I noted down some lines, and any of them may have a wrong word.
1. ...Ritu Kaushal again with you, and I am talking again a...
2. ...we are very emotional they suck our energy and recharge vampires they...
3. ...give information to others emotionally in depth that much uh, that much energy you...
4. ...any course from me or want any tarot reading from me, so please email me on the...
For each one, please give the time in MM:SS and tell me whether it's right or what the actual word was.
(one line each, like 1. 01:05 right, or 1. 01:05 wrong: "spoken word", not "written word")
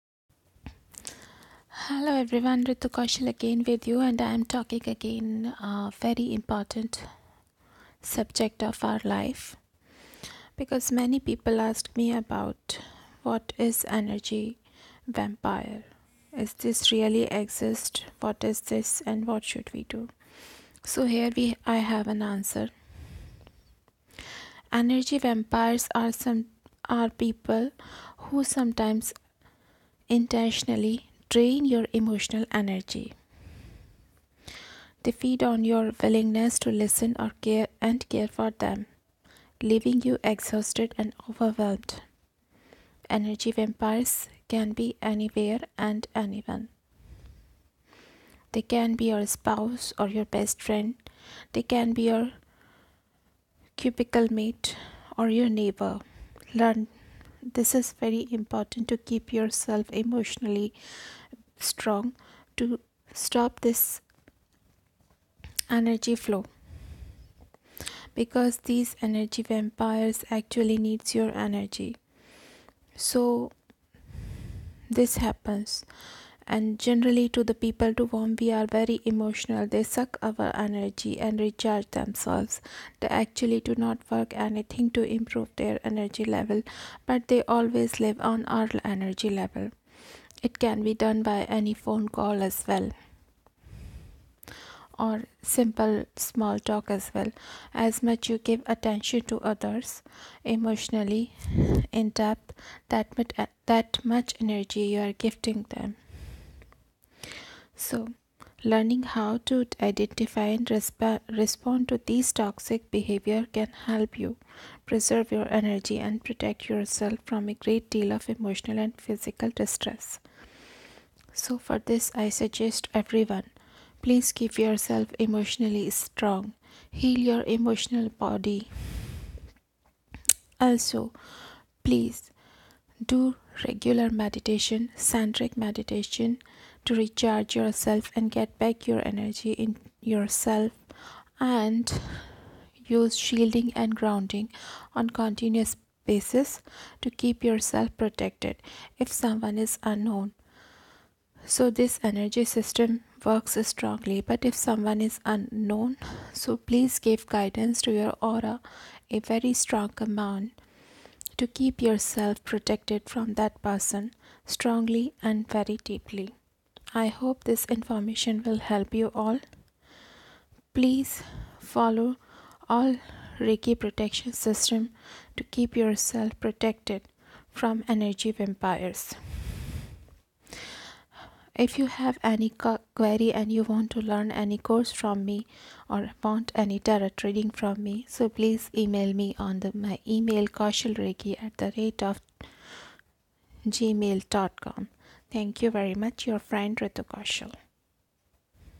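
1. 00:02 right
2. 01:18 wrong: "themselves", not "vampires"
3. 01:38 wrong: "attention", not "information"
4. 03:04 right.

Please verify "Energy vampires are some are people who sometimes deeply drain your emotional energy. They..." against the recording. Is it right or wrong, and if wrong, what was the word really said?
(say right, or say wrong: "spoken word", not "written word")
wrong: "intentionally", not "deeply".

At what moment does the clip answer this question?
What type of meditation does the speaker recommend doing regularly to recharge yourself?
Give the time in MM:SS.
02:14.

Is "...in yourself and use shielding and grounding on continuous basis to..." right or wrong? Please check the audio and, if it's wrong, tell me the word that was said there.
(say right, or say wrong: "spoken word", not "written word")
right.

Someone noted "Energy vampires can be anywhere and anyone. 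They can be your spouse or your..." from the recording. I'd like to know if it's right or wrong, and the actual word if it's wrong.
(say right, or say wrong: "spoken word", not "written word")
right.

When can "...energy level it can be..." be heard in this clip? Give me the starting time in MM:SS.
01:28.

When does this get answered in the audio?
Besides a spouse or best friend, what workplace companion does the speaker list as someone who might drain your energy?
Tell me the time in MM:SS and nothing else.
00:53.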